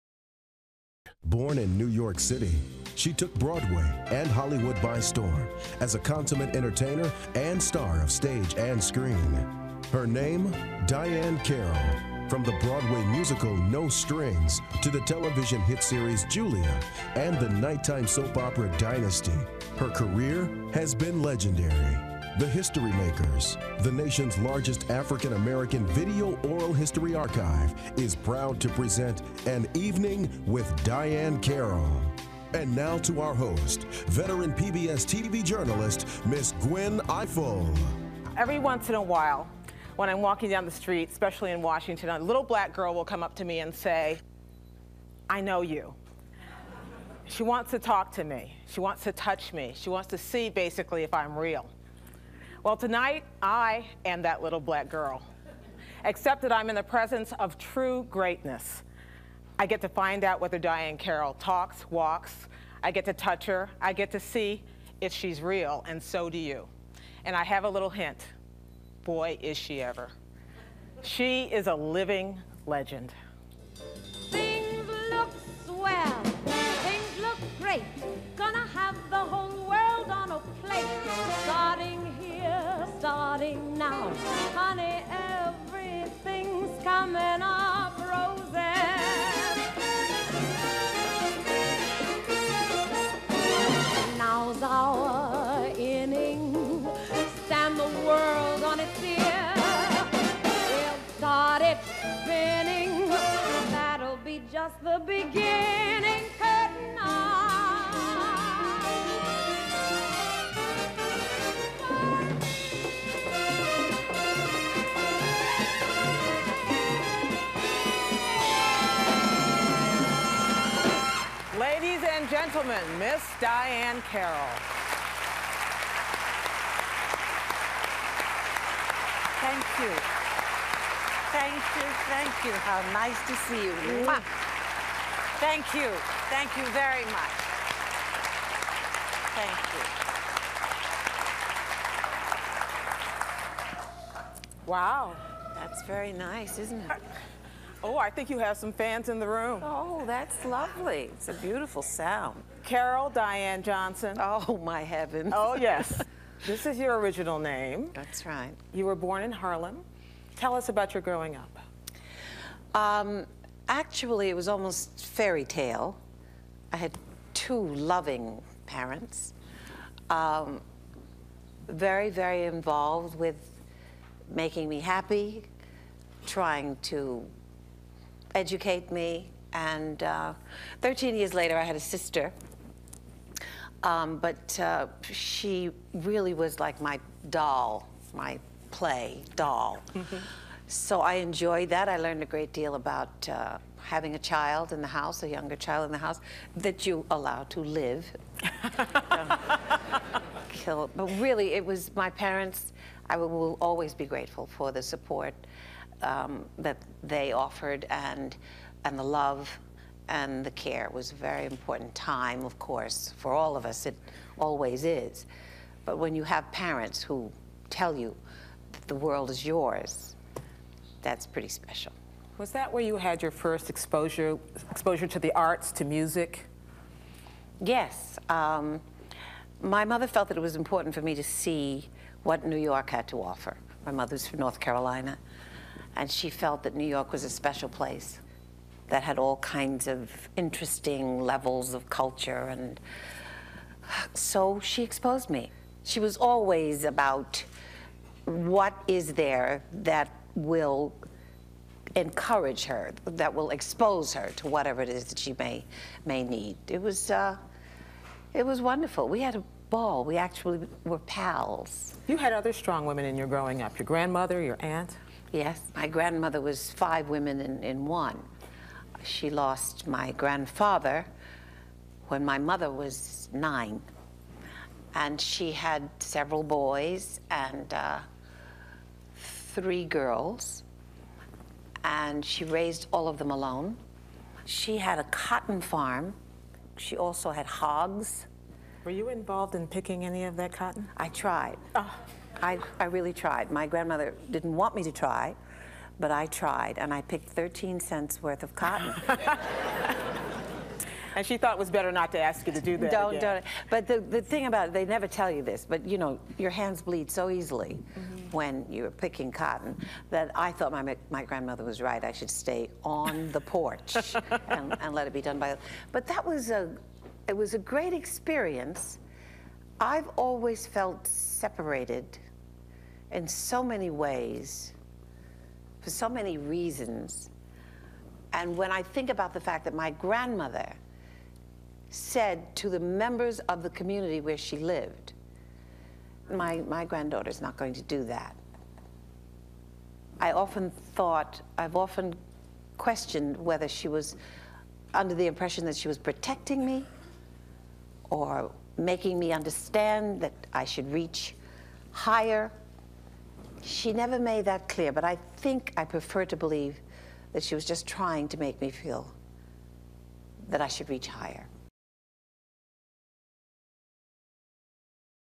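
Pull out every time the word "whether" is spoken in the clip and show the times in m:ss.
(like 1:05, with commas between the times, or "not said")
1:00, 5:43.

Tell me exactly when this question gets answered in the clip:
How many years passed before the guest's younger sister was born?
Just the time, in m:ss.
3:00.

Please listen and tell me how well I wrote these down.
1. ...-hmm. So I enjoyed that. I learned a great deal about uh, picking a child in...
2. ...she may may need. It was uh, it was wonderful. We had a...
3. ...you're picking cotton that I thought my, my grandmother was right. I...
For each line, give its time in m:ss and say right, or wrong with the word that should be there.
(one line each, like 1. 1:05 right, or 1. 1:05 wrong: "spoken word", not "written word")
1. 3:10 wrong: "having", not "picking"
2. 4:15 right
3. 5:08 right.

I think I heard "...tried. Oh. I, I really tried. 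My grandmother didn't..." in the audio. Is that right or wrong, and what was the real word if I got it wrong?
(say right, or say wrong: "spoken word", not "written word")
right.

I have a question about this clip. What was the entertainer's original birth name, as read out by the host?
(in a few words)
Carol Diann Johnson.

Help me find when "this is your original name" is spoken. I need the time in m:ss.
2:36.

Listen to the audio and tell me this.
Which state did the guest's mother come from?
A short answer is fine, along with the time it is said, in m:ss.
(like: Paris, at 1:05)
North Carolina, at 3:54.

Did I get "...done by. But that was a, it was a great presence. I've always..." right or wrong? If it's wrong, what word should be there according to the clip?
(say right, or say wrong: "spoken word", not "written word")
wrong: "experience", not "presence".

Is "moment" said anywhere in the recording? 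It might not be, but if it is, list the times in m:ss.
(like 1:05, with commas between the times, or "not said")
not said.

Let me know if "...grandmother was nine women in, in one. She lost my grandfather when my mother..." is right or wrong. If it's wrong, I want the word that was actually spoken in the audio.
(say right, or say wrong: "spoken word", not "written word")
wrong: "five", not "nine".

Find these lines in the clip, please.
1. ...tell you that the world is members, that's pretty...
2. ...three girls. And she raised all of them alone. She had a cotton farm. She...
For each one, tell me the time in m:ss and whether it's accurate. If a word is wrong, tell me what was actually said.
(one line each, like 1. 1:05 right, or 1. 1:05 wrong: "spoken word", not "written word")
1. 3:37 wrong: "yours", not "members"
2. 4:39 right.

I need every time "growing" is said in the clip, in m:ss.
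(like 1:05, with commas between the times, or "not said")
2:41, 4:23.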